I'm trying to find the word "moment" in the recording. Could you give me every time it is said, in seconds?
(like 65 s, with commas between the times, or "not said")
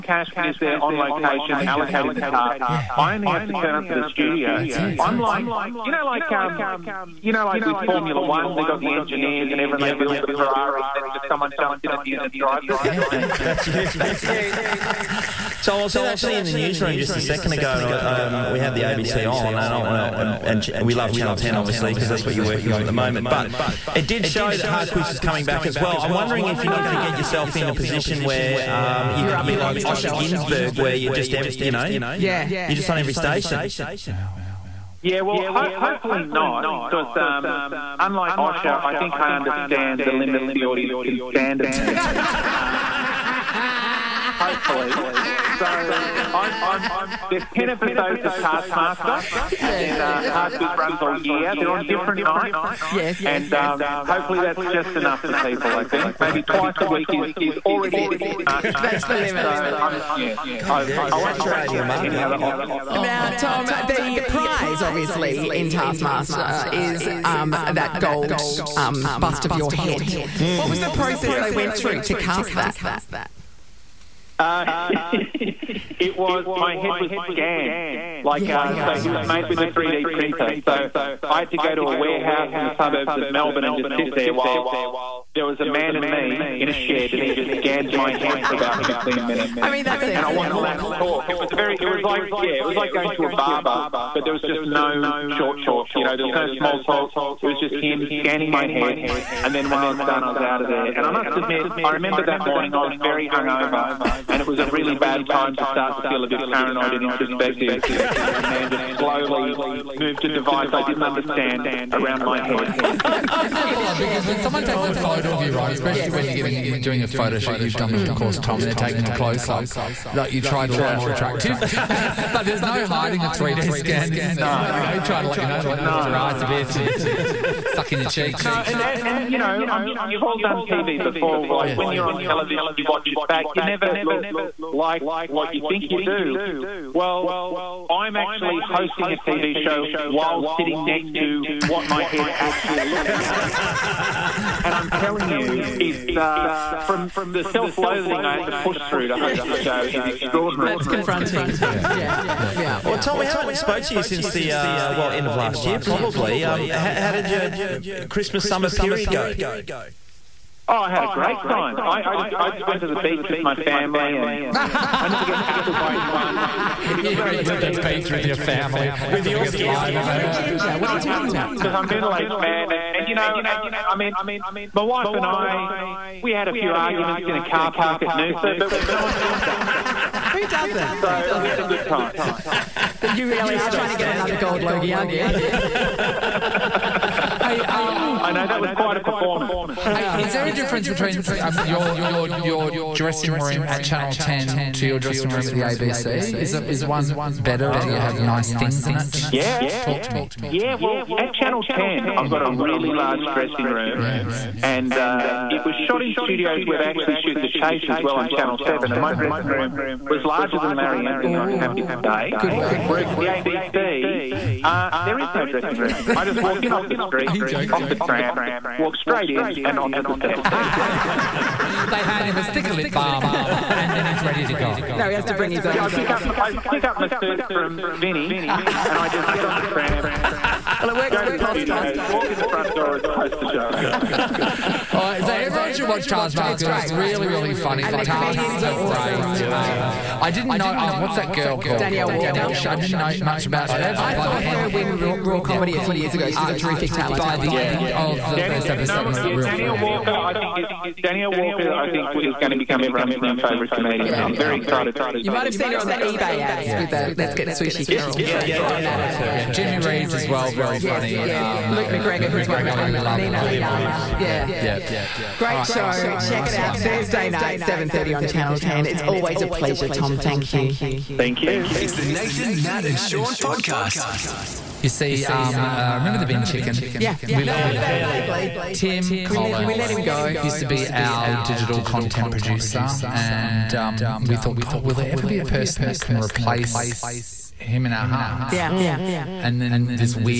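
22 s.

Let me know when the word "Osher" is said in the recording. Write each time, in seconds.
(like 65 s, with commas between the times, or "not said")
29 s, 38 s.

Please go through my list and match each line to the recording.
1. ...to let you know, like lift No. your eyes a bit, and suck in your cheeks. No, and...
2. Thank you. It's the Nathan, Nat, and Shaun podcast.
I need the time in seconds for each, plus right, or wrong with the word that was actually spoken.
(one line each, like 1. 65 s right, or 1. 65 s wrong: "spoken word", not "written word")
1. 125 s right
2. 271 s right.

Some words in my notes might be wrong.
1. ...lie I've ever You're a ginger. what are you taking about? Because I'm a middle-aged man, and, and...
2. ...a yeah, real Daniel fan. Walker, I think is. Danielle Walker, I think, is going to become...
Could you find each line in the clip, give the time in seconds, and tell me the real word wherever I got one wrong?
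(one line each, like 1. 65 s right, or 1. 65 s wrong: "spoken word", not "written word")
1. 169 s wrong: "talking", not "taking"
2. 249 s right.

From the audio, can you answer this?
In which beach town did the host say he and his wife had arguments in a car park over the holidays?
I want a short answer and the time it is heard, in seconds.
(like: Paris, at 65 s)
Noosa, at 178 s.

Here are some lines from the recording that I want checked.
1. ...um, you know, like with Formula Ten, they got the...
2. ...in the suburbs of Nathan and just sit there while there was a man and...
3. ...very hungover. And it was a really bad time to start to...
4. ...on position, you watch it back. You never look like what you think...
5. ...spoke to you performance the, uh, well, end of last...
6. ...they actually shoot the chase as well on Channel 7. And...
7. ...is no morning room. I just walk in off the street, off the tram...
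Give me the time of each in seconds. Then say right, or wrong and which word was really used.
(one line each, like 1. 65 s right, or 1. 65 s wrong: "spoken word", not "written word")
1. 6 s wrong: "One", not "Ten"
2. 82 s wrong: "Melbourne", not "Nathan"
3. 103 s right
4. 132 s wrong: "television", not "position"
5. 153 s wrong: "since", not "performance"
6. 206 s right
7. 215 s wrong: "dressing", not "morning".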